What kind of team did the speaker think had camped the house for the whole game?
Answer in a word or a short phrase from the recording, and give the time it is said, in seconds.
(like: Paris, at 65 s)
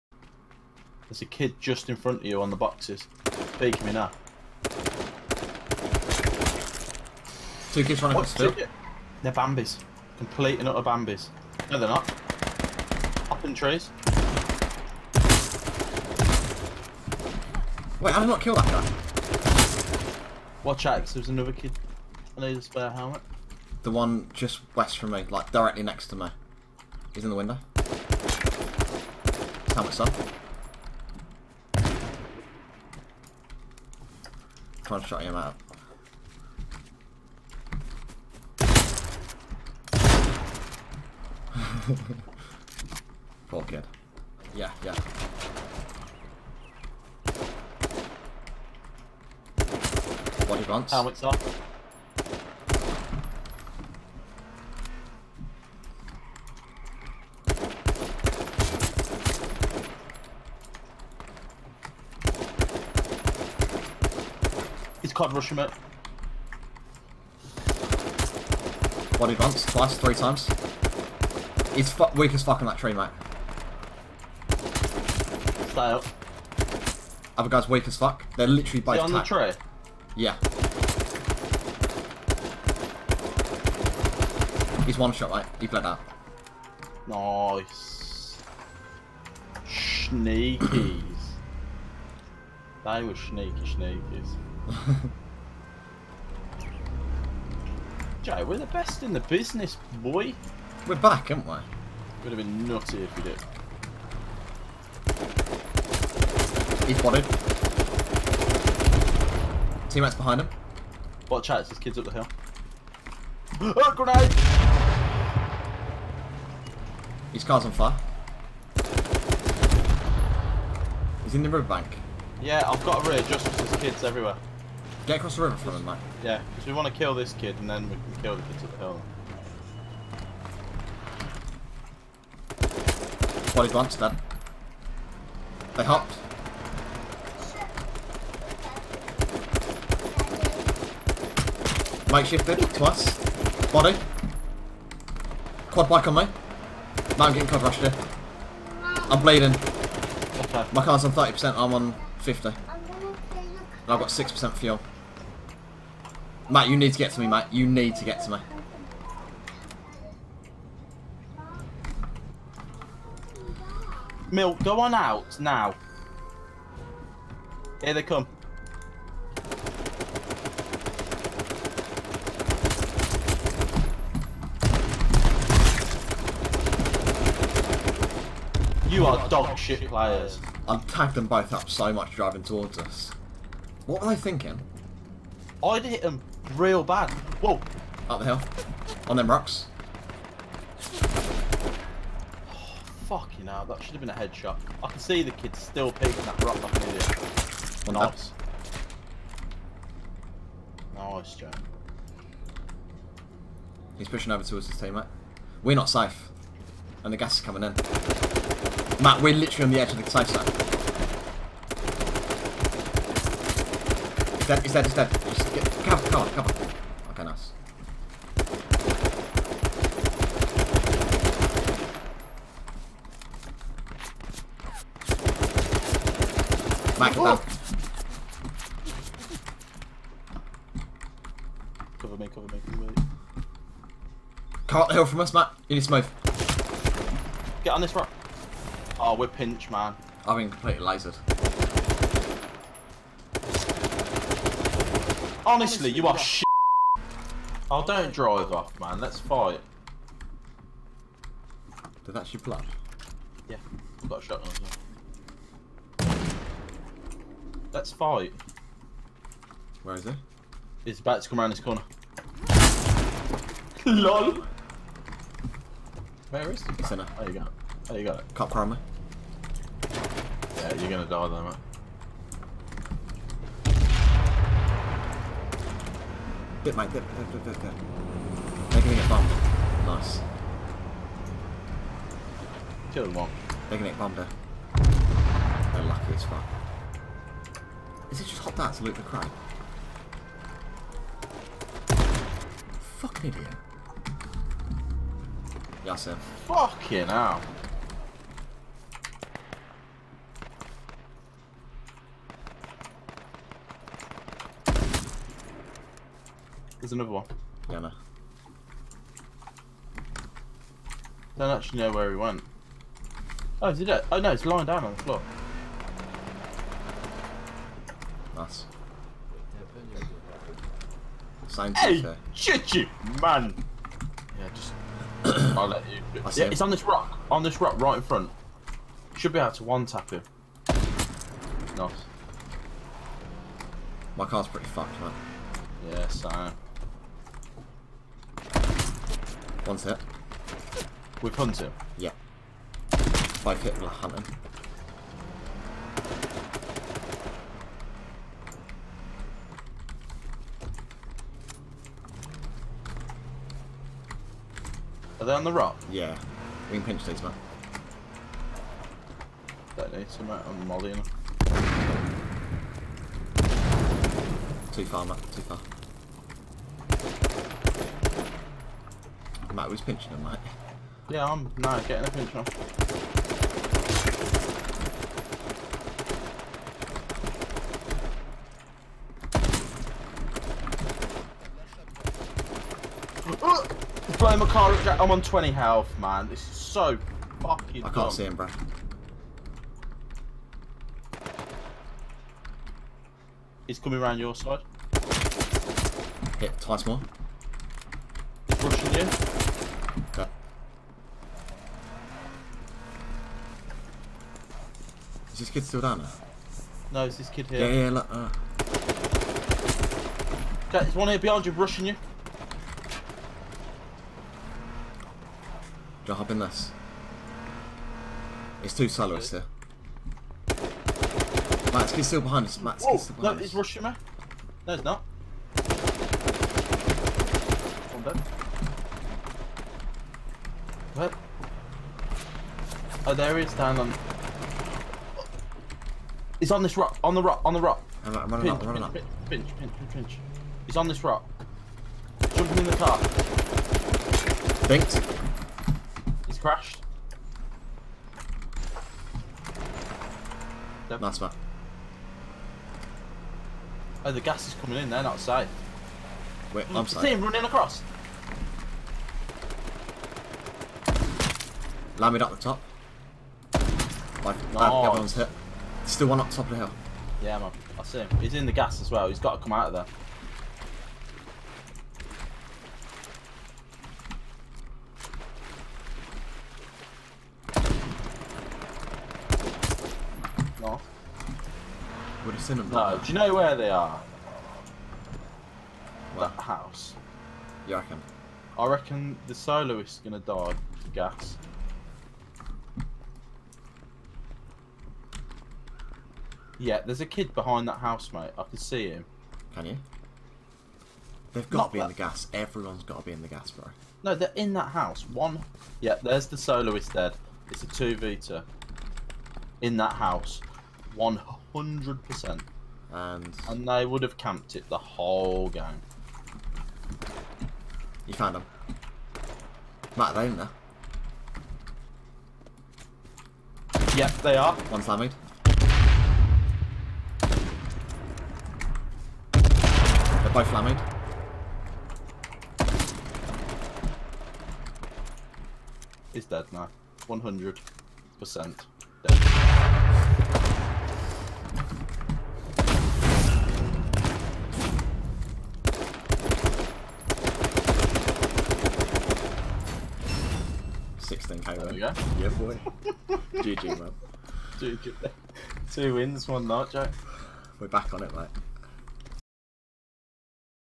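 2 vita, at 507 s.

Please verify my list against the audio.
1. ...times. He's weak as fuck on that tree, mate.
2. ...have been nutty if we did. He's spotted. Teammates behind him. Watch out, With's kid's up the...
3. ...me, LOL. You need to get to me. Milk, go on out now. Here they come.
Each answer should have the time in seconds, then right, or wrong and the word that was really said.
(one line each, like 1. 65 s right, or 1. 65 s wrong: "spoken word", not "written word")
1. 70 s right
2. 102 s wrong: "There", not "With"
3. 157 s wrong: "Matt", not "LOL".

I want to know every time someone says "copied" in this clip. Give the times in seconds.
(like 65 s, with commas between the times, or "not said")
not said.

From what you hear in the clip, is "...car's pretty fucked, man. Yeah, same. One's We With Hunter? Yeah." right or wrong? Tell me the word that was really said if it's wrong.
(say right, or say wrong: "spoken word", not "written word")
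right.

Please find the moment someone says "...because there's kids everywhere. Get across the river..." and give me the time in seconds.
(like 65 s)
123 s.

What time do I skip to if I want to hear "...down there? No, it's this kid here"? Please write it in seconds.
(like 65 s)
405 s.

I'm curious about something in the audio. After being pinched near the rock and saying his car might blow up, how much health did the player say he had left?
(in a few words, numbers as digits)
20.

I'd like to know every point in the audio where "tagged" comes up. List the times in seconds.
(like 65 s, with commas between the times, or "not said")
180 s.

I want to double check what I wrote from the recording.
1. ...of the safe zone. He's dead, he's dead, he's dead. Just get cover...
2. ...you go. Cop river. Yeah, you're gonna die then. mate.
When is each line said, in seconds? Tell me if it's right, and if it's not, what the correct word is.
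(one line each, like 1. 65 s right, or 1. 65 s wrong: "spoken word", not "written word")
1. 209 s right
2. 267 s wrong: "crammer", not "river".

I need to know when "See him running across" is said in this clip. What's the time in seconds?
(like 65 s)
457 s.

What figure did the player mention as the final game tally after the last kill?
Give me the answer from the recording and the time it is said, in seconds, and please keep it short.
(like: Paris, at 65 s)
16K, at 550 s.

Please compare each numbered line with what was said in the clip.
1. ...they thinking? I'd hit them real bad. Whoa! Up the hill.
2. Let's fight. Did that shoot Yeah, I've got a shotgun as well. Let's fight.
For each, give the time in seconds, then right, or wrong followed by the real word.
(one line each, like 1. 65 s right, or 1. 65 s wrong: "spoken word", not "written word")
1. 184 s right
2. 248 s right.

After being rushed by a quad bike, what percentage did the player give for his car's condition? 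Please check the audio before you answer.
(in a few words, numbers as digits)
30%.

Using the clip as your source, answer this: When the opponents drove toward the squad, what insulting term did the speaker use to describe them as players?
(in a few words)
dog shit players.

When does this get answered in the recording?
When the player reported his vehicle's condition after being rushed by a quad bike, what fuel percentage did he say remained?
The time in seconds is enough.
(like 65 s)
154 s.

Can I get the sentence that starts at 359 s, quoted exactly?
That needs to out on Molly.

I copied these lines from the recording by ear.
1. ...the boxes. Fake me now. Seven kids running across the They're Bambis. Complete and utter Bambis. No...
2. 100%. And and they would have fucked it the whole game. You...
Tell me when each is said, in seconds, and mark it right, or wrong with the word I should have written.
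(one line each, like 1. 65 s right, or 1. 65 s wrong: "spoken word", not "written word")
1. 2 s wrong: "Two", not "Seven"
2. 510 s wrong: "camped", not "fucked".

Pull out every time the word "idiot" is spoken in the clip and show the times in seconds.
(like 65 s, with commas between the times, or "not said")
196 s, 293 s.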